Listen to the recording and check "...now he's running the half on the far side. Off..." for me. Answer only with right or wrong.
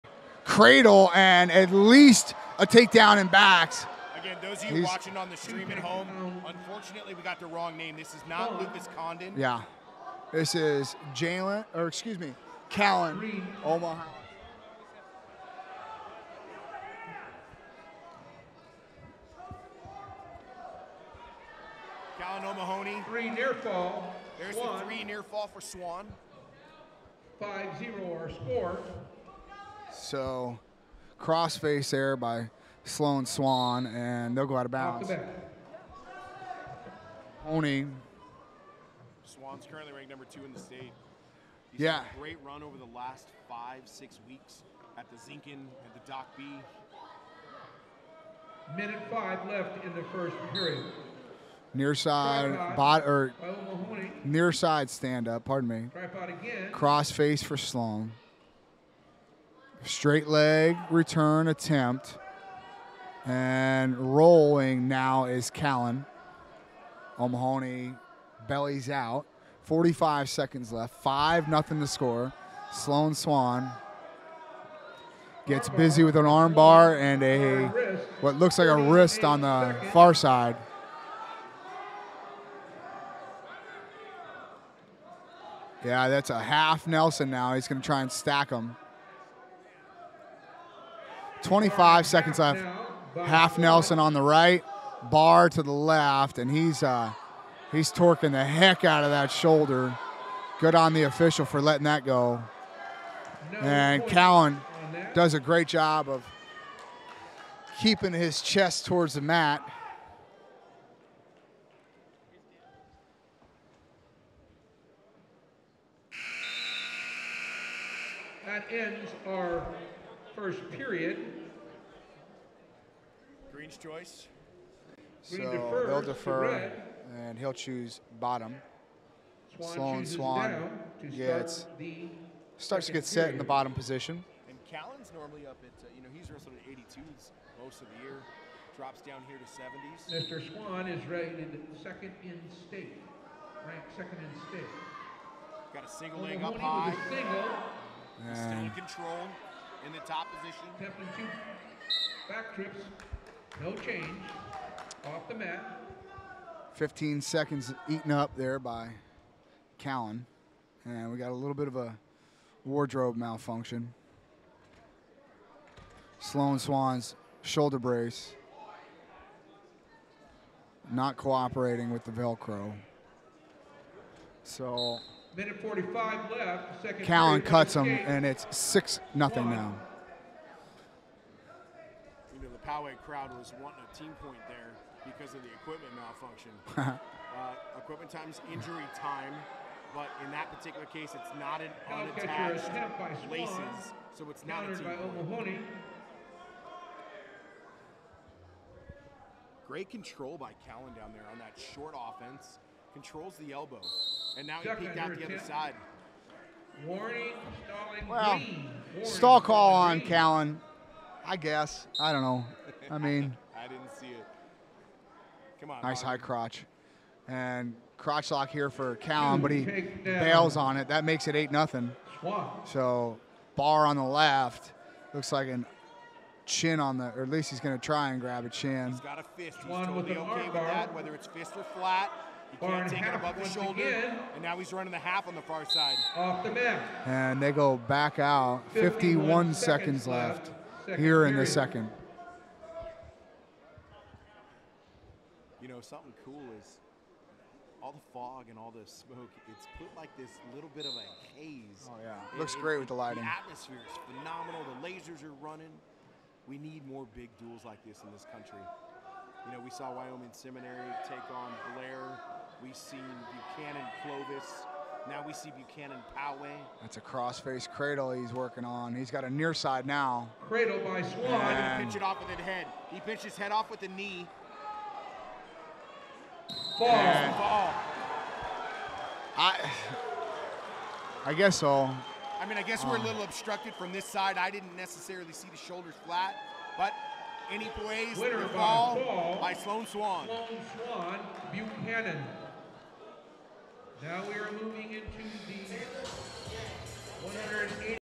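right.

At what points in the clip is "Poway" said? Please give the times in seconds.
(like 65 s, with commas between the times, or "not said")
182 s, 266 s.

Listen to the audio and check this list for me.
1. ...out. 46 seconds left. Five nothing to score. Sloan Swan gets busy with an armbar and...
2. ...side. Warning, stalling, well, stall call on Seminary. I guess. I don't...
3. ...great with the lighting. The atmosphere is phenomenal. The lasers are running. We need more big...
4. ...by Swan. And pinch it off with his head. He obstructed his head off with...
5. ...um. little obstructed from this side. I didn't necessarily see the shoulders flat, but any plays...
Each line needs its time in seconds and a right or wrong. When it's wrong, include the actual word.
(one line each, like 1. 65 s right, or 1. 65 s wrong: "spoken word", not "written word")
1. 68 s wrong: "45", not "46"
2. 205 s wrong: "Callen", not "Seminary"
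3. 252 s right
4. 270 s wrong: "pinched", not "obstructed"
5. 282 s right.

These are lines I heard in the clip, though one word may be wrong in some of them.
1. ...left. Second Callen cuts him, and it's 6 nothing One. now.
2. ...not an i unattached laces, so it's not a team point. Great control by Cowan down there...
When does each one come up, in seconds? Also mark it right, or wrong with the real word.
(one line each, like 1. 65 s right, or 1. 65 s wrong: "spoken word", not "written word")
1. 176 s right
2. 191 s wrong: "Callen", not "Cowan".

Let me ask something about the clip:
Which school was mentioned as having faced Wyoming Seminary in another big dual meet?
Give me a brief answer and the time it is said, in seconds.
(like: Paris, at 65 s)
Davis, at 264 s.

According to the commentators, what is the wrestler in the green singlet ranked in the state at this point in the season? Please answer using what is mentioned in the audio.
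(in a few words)
number 2.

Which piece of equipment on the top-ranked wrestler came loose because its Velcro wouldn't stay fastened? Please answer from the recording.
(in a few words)
Shoulder brace.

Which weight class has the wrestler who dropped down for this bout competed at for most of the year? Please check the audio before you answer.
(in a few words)
182.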